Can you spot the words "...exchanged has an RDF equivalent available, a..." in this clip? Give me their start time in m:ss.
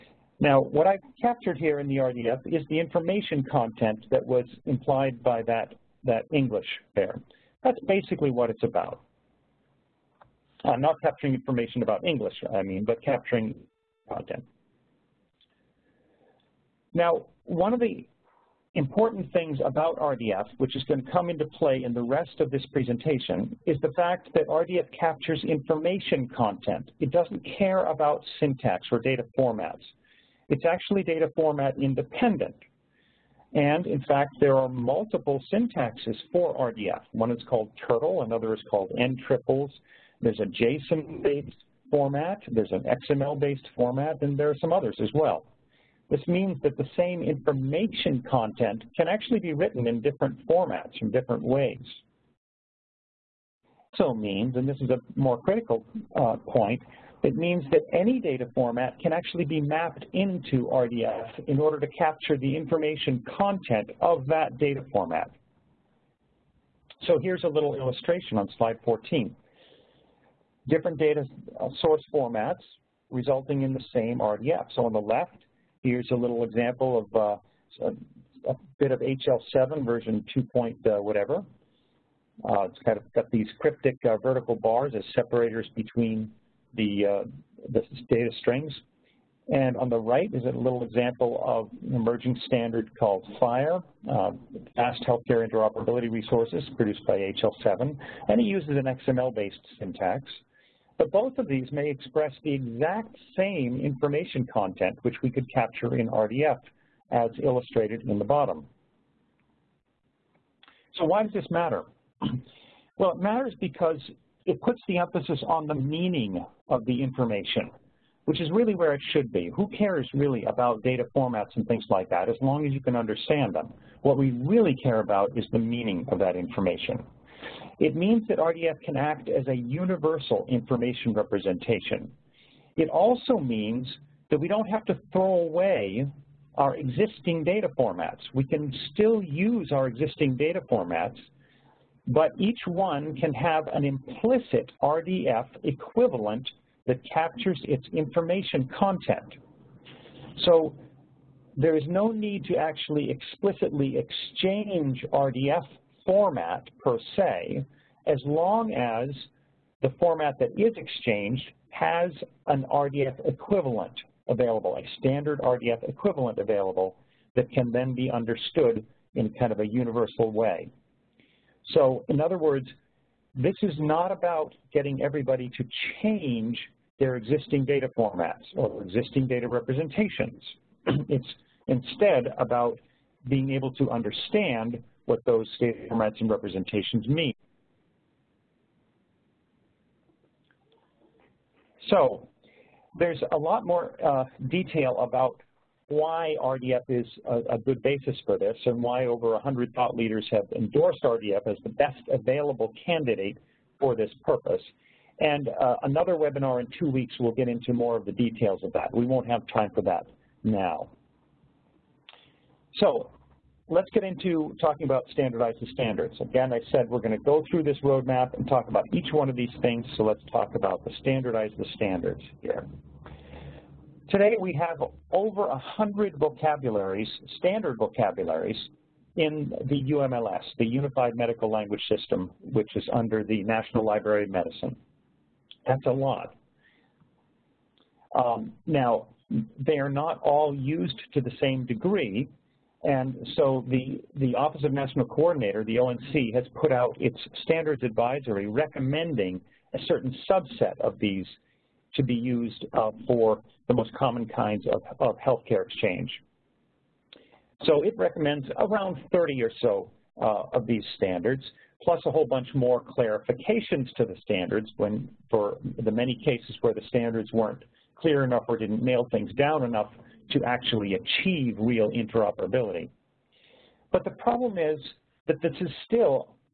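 2:40.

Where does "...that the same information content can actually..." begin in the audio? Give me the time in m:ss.
0:46.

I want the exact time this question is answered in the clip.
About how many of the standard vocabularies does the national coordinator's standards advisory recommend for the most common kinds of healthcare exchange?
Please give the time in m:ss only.
4:18.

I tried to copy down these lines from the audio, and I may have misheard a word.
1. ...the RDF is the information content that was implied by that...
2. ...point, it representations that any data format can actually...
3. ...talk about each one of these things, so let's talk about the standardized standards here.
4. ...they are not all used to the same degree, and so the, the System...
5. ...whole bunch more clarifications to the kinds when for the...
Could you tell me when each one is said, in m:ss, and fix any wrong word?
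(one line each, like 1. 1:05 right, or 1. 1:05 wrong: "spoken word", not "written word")
1. 0:01 right
2. 0:56 wrong: "means", not "representations"
3. 3:38 right
4. 3:59 wrong: "Office", not "System"
5. 4:22 wrong: "standards", not "kinds".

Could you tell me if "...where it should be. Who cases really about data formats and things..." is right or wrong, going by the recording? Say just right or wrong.
wrong.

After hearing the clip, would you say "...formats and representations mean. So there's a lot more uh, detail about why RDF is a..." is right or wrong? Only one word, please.
right.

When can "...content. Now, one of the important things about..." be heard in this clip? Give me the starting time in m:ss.
0:14.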